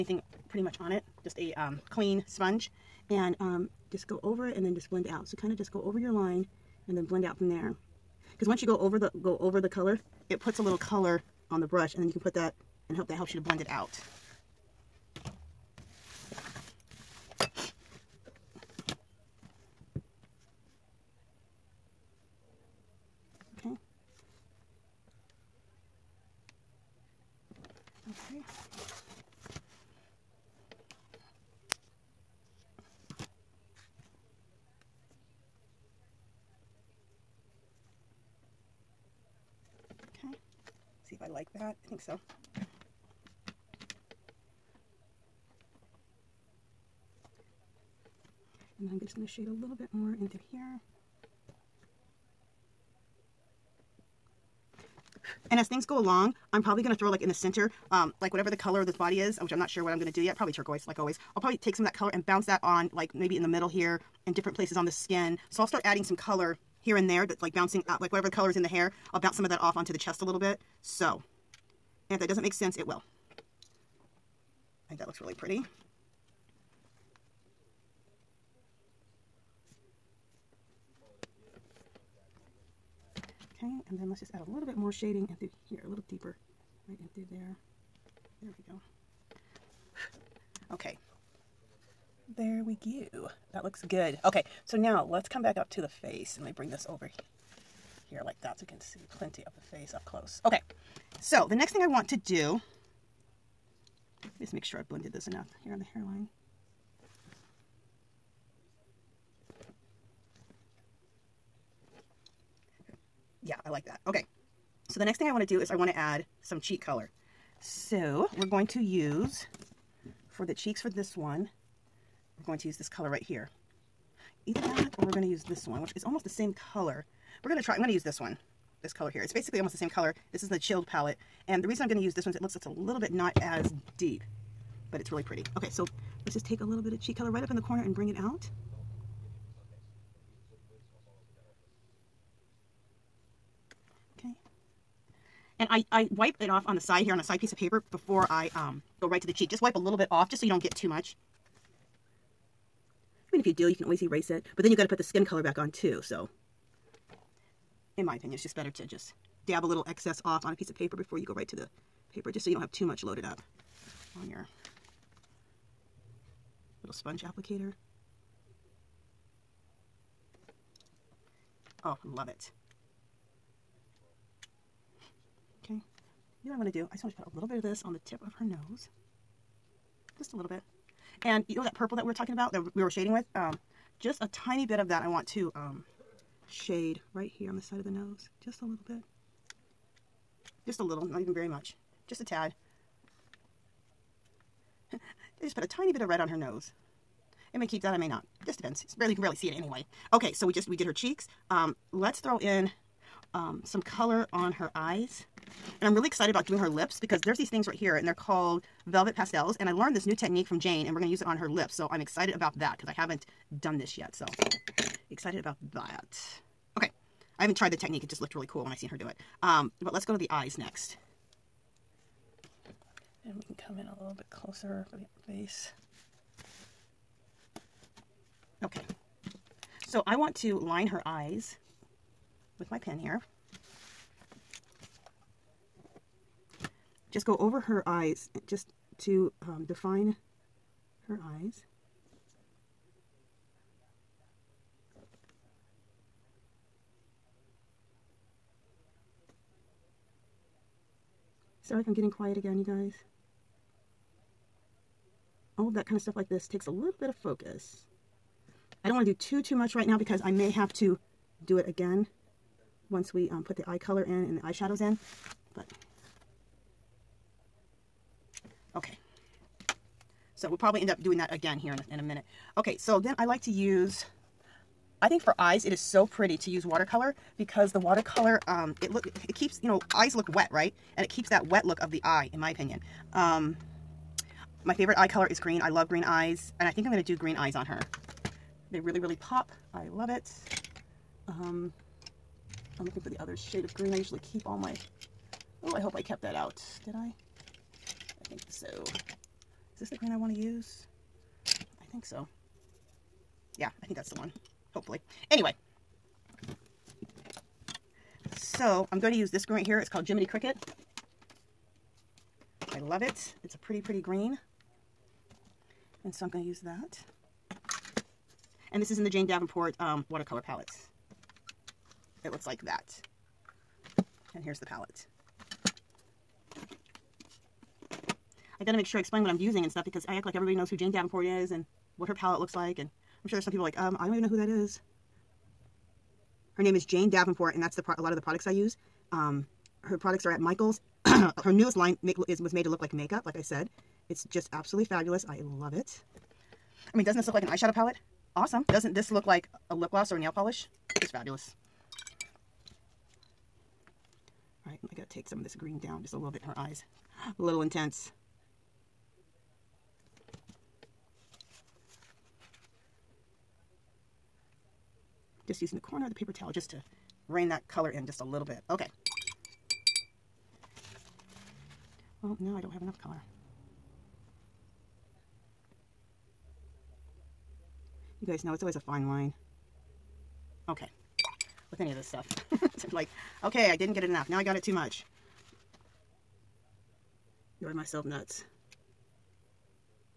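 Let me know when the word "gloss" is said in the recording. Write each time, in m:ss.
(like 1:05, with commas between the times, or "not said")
5:49.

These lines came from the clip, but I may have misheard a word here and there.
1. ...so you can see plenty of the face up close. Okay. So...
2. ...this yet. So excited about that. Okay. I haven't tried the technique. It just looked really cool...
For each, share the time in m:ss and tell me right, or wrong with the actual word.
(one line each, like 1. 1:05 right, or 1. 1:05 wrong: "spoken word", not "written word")
1. 1:38 right
2. 3:33 right.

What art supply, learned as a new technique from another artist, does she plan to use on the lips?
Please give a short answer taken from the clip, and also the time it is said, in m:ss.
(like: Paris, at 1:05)
Velvet Pastels, at 3:28.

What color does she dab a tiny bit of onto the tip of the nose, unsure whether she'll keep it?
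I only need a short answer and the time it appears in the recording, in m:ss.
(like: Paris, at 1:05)
Red, at 3:16.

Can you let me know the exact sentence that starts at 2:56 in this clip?
I just want to put a little bit of this on the tip of her nose.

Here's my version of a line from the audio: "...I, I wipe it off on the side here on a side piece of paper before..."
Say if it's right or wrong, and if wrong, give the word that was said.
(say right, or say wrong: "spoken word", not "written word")
right.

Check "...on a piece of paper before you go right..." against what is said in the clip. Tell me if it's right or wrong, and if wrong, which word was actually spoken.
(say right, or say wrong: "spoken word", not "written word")
right.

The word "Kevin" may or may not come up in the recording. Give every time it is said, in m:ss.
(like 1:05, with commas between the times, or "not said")
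not said.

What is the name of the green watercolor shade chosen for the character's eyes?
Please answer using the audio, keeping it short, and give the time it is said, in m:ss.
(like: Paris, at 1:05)
Jiminy Cricket, at 5:10.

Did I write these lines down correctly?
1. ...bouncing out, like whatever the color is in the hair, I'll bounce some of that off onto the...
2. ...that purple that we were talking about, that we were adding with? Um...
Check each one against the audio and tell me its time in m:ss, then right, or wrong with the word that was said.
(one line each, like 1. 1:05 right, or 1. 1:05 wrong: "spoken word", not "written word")
1. 1:07 right
2. 3:01 wrong: "shading", not "adding".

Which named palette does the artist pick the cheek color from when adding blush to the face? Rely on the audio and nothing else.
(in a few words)
The chilled palette.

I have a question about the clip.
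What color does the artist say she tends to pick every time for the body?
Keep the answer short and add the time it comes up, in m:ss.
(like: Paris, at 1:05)
Turquoise, at 1:00.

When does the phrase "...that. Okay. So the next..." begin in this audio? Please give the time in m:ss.
1:53.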